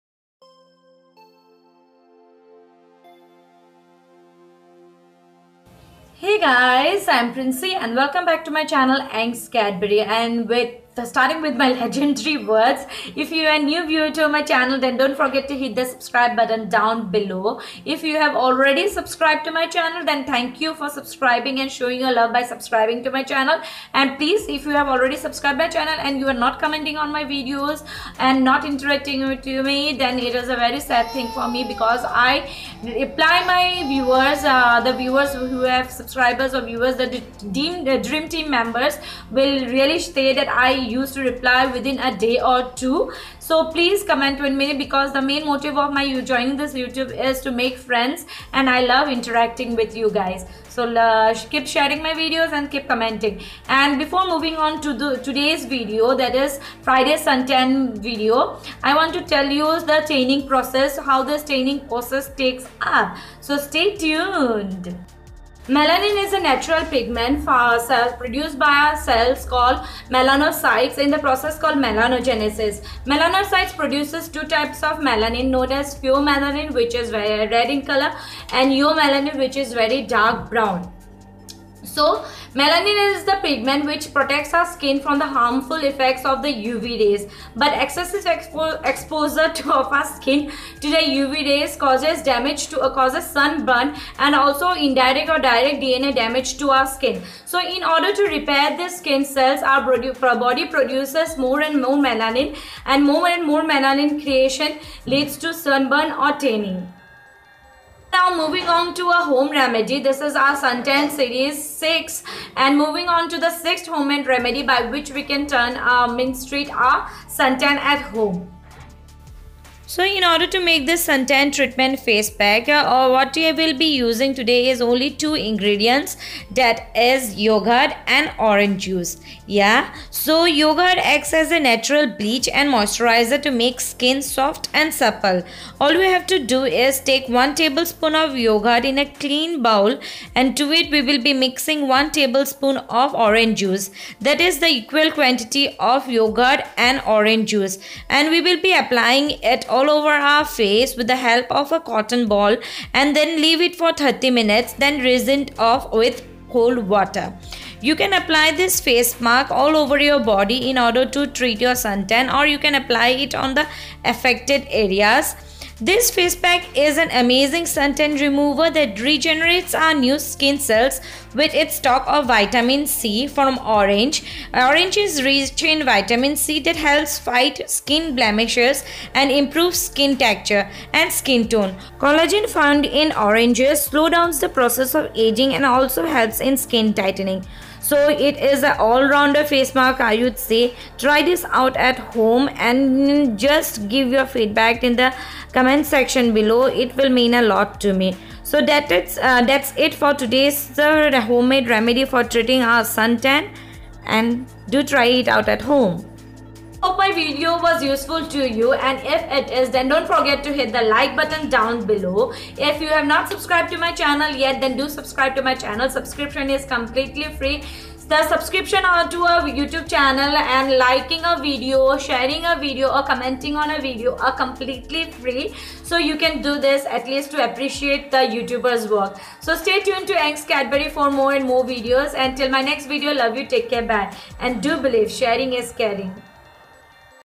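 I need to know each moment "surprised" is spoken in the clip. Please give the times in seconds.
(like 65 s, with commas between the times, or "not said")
not said.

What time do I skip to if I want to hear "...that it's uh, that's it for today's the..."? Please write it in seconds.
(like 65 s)
198 s.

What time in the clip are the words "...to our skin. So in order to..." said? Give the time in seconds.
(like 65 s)
96 s.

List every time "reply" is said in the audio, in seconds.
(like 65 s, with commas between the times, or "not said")
32 s, 41 s.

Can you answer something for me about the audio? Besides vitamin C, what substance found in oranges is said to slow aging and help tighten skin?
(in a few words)
Collagen.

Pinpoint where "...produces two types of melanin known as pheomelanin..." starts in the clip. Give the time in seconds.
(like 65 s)
73 s.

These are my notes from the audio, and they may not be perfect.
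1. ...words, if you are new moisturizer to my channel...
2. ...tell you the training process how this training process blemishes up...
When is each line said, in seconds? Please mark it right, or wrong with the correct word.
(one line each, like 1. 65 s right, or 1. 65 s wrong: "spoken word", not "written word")
1. 12 s wrong: "viewer", not "moisturizer"
2. 59 s wrong: "takes", not "blemishes".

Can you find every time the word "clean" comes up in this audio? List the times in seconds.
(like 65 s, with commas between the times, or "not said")
139 s.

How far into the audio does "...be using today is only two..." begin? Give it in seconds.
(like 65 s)
123 s.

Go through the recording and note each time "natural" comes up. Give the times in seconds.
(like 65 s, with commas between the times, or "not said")
66 s, 131 s.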